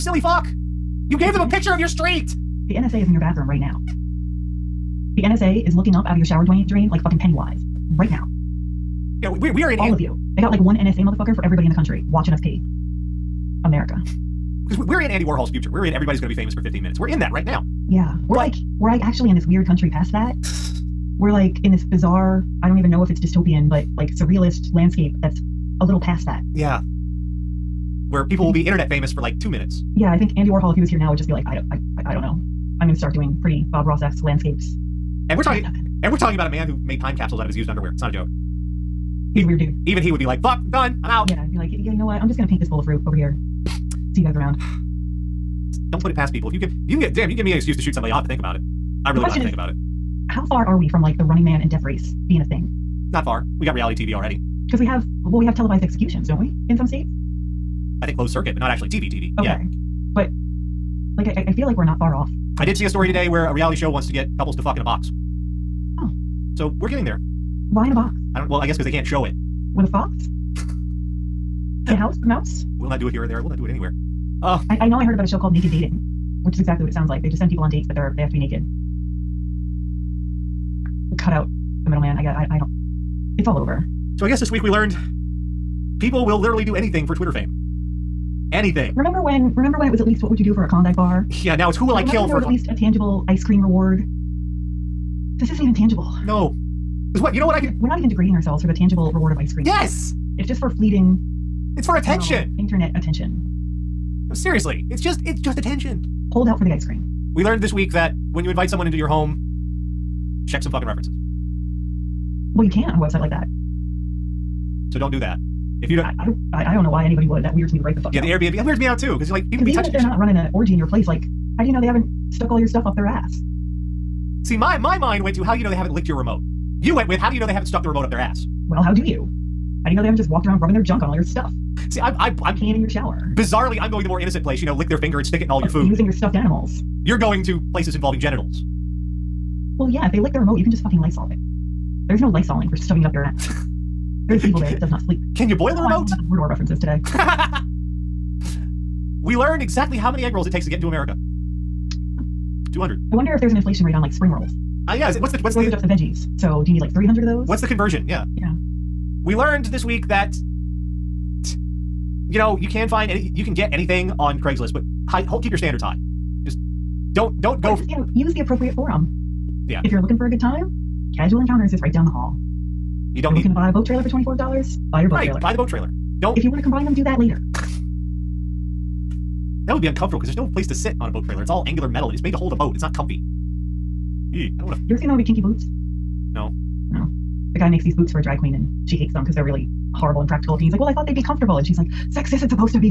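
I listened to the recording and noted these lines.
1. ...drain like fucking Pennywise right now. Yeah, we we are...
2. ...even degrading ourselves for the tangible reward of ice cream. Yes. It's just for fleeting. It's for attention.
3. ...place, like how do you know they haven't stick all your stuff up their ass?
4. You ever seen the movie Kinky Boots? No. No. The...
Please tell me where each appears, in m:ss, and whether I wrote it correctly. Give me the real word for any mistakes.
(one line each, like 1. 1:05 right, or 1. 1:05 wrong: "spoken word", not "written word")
1. 0:06 right
2. 1:37 right
3. 2:00 wrong: "stuck", not "stick"
4. 3:04 right.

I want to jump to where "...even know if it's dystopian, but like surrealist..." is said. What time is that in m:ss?
0:22.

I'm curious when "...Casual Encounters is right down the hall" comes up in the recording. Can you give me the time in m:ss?
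2:51.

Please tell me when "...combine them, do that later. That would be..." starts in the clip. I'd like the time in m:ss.
2:56.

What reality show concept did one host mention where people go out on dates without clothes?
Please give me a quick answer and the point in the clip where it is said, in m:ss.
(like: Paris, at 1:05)
Naked Dating, at 1:15.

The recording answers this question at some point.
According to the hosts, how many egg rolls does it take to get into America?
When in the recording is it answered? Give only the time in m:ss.
2:32.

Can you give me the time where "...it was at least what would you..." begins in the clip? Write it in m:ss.
1:29.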